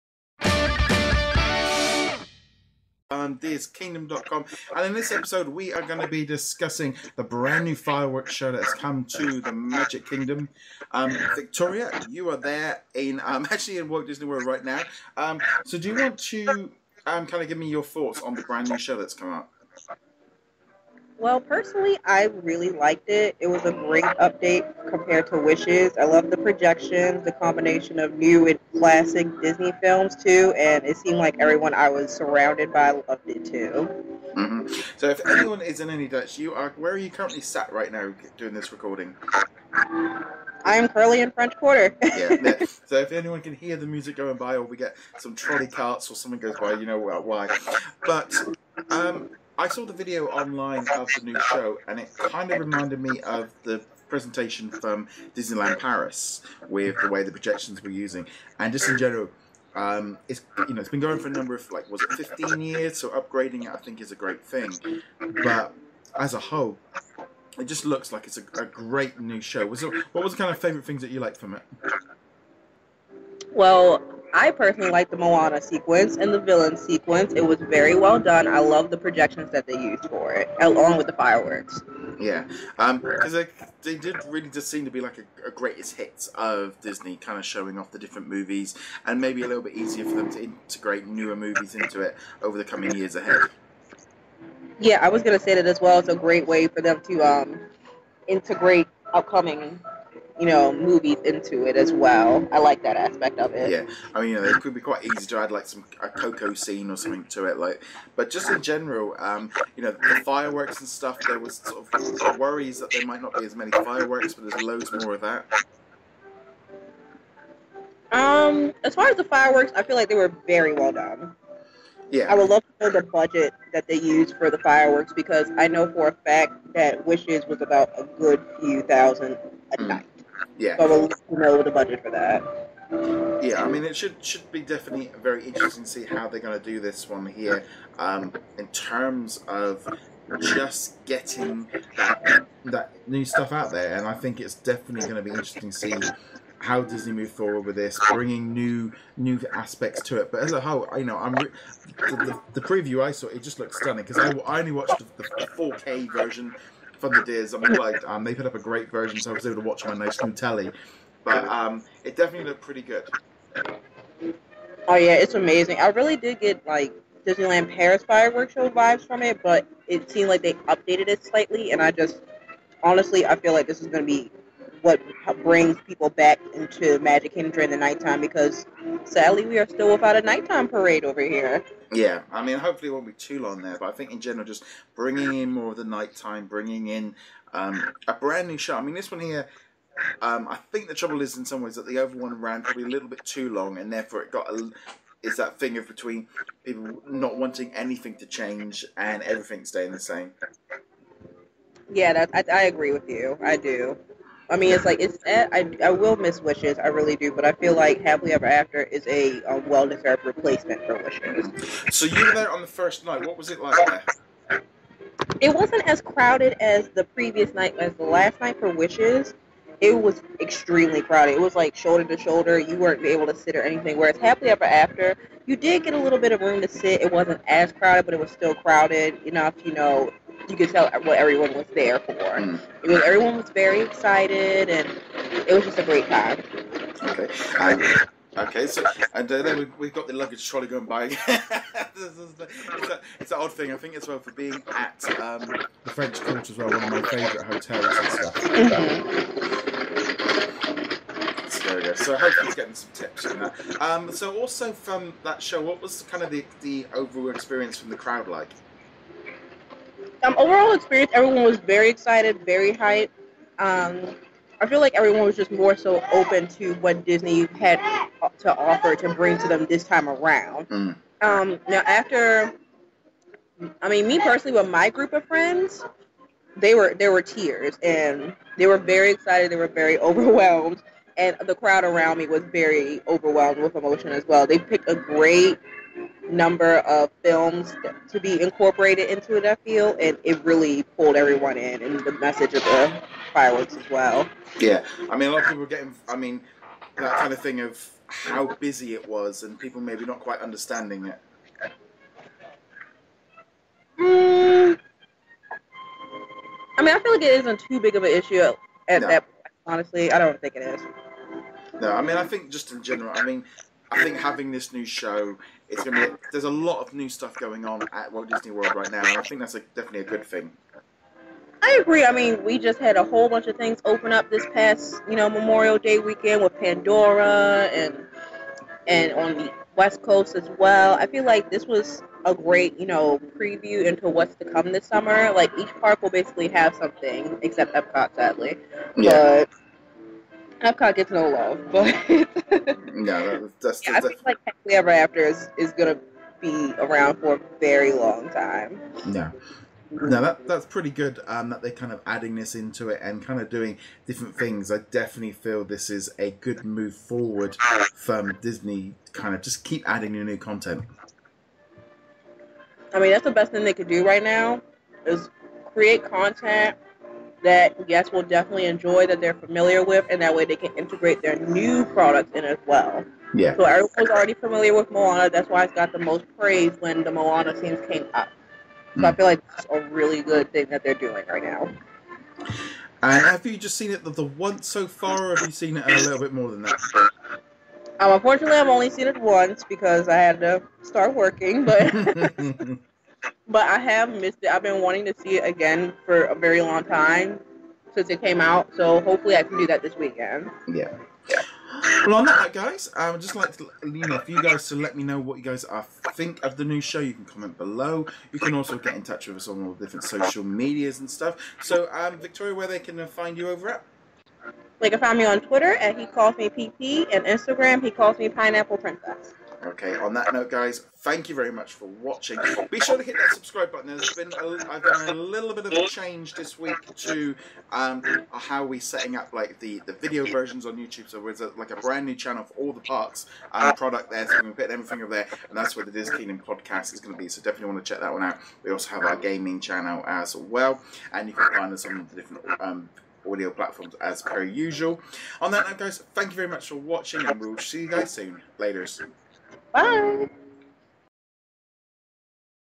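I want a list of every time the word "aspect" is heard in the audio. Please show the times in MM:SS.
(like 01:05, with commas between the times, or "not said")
01:42, 02:29.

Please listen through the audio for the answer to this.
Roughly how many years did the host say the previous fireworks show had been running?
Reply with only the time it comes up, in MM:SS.
01:02.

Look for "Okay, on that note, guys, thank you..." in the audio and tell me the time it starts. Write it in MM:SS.
06:59.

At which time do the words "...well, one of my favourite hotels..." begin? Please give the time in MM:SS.
04:06.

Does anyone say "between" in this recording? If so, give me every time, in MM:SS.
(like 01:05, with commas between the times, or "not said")
03:15.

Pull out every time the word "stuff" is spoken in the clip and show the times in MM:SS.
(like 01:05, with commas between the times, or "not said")
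01:50, 02:23, 04:08, 05:17, 06:51.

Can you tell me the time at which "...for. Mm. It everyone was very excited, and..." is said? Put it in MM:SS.
03:51.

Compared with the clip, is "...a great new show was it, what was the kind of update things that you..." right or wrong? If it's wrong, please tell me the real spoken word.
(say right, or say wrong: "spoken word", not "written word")
wrong: "favorite", not "update".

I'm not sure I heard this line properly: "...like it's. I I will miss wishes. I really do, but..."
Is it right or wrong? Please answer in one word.
right.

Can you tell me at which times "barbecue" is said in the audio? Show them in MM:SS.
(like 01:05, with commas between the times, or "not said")
not said.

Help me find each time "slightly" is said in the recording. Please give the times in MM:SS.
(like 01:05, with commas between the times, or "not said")
02:51.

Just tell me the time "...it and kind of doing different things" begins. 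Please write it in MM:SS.
05:52.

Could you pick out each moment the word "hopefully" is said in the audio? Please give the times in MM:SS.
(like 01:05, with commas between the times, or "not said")
03:02, 04:12, 06:39.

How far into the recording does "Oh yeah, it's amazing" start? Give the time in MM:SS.
02:44.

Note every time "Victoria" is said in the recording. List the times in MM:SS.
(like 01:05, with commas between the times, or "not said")
00:11, 06:52.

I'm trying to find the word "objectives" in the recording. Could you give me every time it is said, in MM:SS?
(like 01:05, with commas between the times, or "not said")
not said.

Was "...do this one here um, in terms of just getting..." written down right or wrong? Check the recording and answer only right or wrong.
right.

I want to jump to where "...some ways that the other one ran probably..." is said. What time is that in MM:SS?
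03:11.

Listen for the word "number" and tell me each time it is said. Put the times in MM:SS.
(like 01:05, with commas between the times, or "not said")
01:01, 04:46.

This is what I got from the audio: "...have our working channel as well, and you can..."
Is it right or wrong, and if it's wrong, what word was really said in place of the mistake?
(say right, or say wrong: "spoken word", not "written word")
wrong: "gaming", not "working".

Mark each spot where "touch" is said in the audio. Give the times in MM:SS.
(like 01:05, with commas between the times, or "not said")
06:49.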